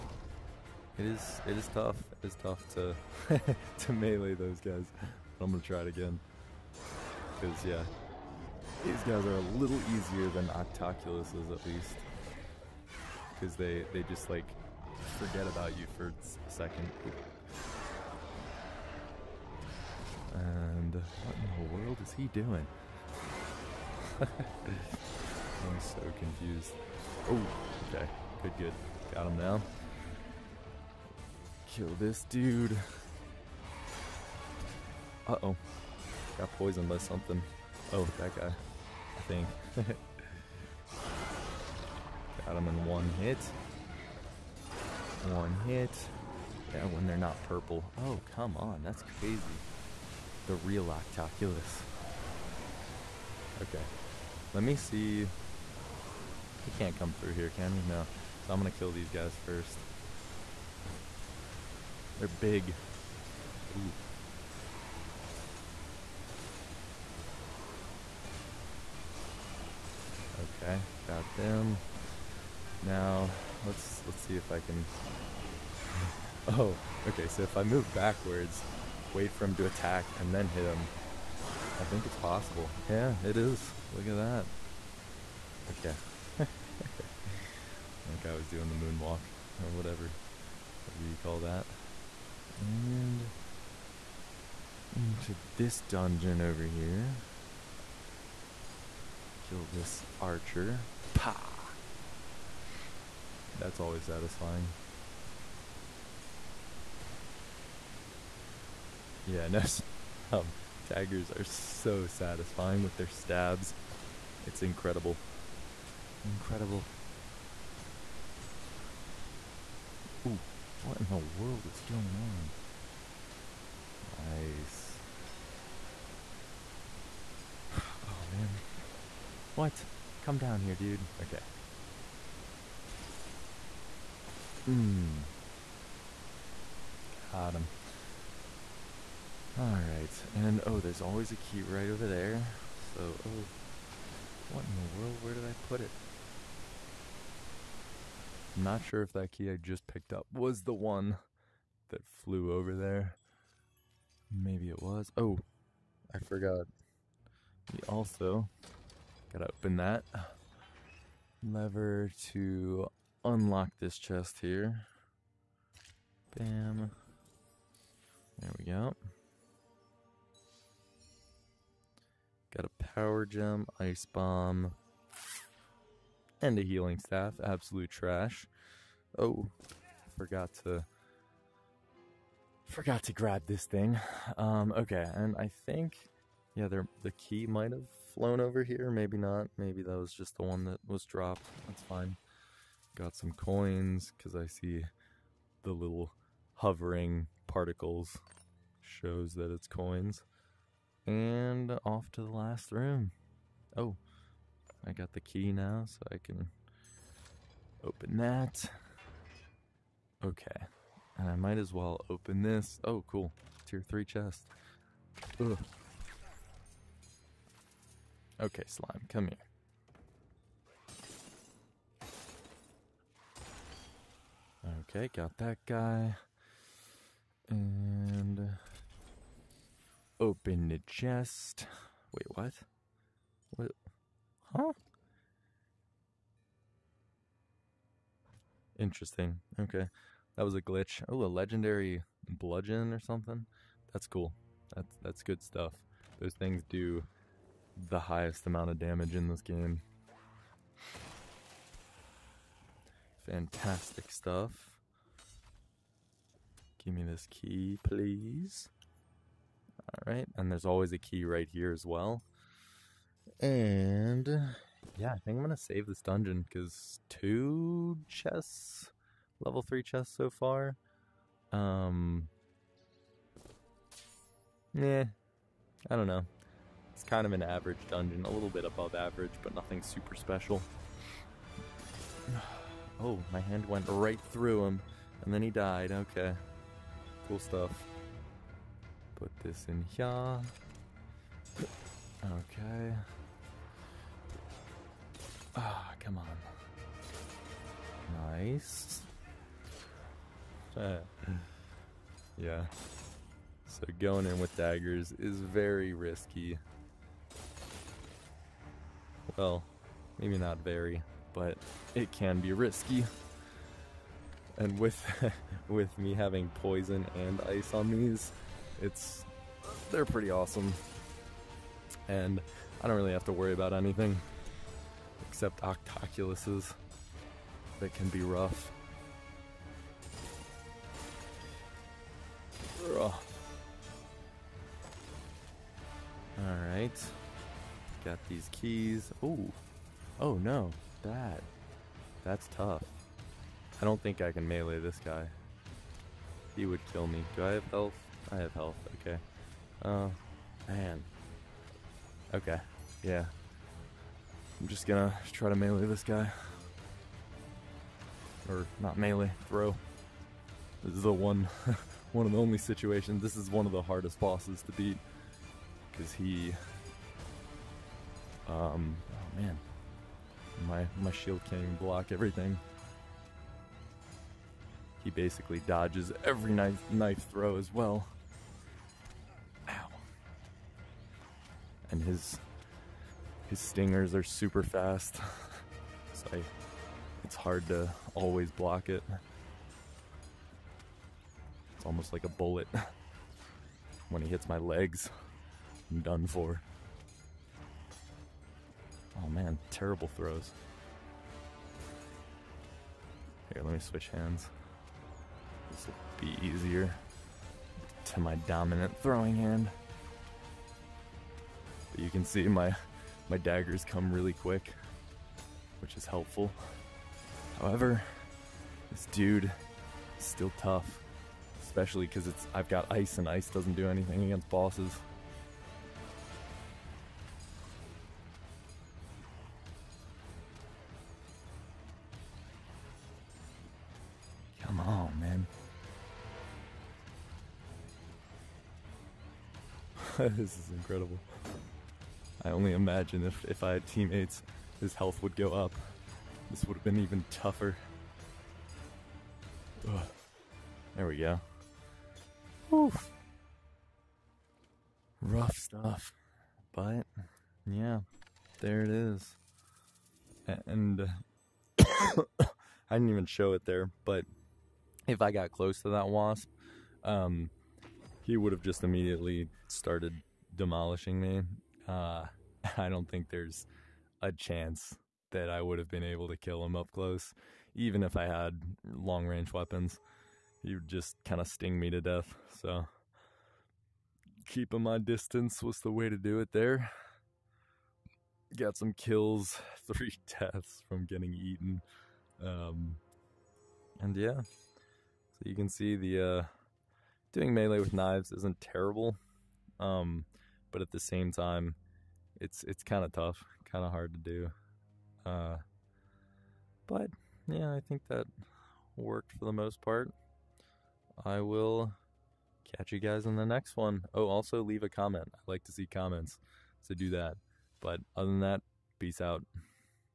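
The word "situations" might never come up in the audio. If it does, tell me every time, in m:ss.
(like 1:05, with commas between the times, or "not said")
6:02.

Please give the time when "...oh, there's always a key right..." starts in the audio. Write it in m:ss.
2:20.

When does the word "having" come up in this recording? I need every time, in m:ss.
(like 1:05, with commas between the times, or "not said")
5:16.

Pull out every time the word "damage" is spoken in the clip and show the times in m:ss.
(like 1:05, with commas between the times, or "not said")
4:08.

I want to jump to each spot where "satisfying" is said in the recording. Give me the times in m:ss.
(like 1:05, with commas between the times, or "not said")
1:44, 1:52.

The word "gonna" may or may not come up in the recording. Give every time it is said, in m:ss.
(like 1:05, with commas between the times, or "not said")
0:05, 4:25, 5:54.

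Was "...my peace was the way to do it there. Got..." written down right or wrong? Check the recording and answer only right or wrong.
wrong.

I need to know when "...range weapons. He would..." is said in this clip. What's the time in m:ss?
7:59.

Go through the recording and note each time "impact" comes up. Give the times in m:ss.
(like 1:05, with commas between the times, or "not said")
not said.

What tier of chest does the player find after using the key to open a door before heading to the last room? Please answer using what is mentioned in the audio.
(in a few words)
3.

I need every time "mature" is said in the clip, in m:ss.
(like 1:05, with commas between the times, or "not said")
not said.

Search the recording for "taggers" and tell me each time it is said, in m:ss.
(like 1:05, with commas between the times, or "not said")
1:50.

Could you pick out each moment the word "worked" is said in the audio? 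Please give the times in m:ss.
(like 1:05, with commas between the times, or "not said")
8:28.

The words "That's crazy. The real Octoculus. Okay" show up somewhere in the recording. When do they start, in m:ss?
0:48.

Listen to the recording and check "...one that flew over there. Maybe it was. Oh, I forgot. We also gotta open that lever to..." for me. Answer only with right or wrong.
right.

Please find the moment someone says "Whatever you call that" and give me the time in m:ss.
1:30.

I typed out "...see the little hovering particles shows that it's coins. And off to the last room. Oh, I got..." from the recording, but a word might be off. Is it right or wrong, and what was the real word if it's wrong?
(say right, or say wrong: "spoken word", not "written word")
right.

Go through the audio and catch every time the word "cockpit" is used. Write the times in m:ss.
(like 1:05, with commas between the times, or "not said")
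not said.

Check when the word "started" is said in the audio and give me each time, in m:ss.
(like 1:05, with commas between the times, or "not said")
7:49.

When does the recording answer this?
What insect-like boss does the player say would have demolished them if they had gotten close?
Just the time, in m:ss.
7:46.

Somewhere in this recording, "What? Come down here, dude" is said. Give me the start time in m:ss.
2:09.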